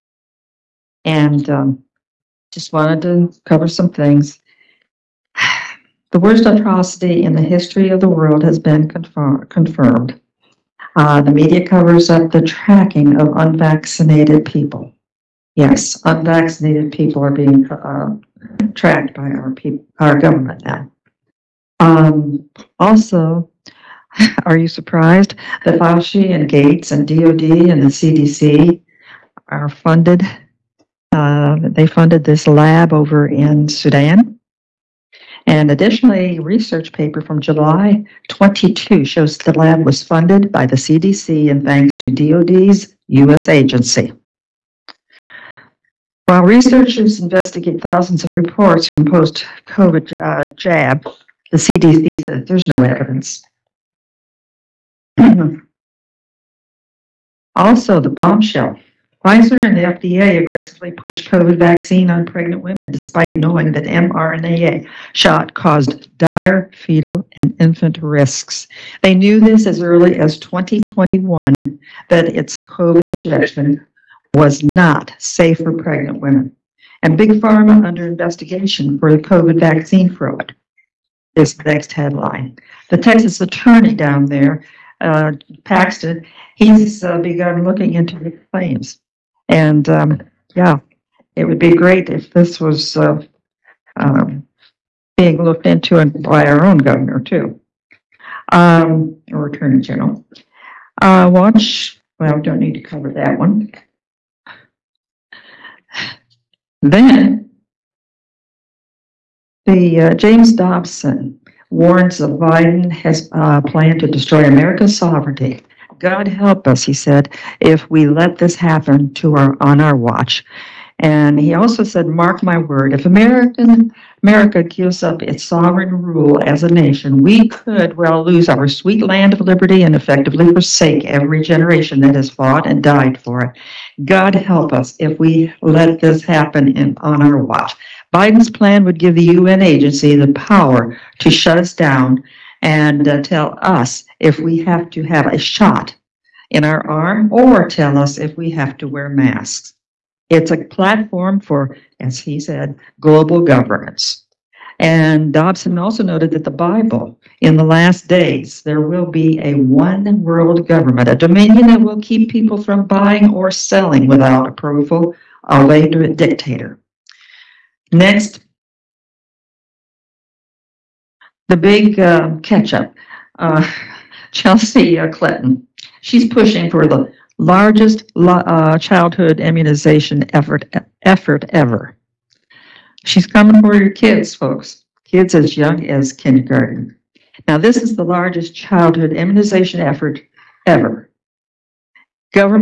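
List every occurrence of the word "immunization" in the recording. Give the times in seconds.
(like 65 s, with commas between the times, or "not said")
179 s, 189 s.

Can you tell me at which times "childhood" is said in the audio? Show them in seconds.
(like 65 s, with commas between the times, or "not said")
178 s, 188 s.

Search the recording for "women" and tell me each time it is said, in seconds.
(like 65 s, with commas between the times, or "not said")
62 s, 76 s.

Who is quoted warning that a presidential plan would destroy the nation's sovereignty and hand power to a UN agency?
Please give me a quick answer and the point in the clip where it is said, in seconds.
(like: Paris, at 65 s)
James Dobson, at 110 s.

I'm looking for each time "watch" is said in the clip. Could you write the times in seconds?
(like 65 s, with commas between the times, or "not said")
101 s, 119 s, 137 s.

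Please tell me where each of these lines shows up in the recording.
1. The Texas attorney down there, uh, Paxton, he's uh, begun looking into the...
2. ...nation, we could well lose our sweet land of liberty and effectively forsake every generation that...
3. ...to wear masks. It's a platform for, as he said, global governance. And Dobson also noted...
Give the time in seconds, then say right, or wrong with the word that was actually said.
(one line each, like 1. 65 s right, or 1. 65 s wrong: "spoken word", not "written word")
1. 82 s right
2. 126 s right
3. 148 s right.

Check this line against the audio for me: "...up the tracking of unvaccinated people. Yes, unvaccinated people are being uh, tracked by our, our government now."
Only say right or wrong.
right.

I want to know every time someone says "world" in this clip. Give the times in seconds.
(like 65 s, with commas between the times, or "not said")
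8 s, 160 s.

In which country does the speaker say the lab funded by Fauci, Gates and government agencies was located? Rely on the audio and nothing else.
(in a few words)
Sudan.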